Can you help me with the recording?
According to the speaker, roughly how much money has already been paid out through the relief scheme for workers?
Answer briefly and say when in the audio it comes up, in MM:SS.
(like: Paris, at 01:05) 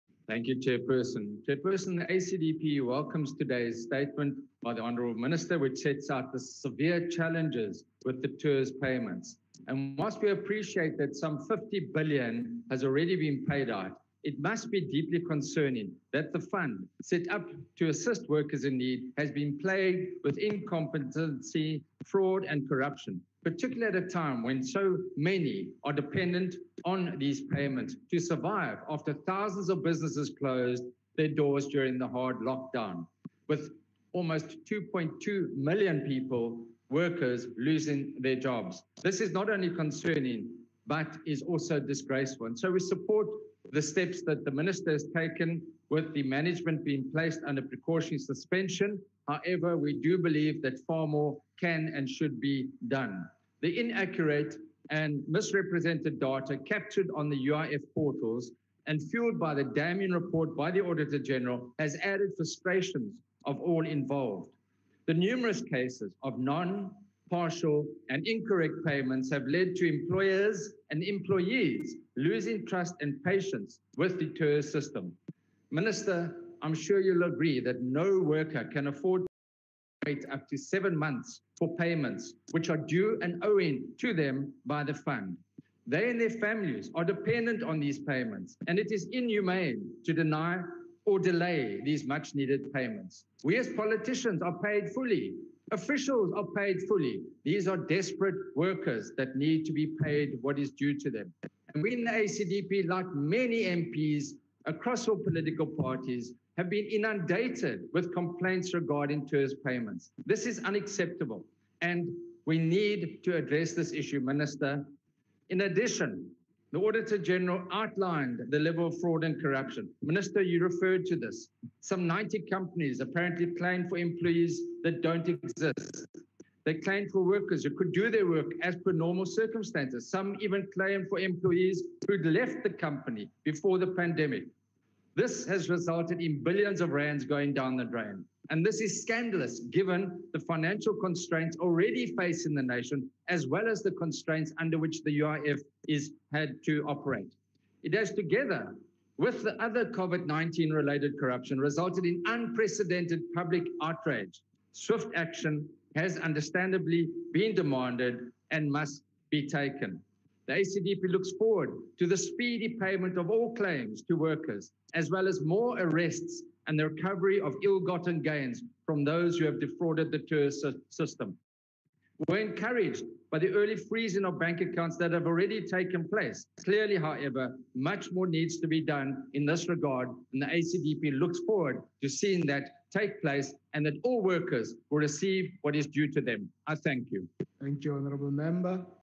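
50 billion, at 00:11.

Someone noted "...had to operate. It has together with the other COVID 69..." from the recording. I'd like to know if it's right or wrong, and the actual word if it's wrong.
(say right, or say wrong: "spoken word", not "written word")
wrong: "19", not "69".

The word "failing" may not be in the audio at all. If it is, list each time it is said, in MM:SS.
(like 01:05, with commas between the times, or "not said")
not said.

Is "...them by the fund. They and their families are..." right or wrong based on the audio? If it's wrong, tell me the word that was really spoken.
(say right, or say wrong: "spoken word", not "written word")
right.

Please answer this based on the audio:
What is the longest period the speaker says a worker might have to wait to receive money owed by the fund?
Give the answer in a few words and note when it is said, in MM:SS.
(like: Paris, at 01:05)
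7 months, at 01:20.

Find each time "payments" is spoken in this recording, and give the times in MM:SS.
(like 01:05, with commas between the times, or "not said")
00:08, 00:27, 01:08, 01:21, 01:27, 01:32, 01:49, 02:42.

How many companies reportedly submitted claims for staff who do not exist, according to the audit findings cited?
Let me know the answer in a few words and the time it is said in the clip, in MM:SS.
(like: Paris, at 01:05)
90, at 02:02.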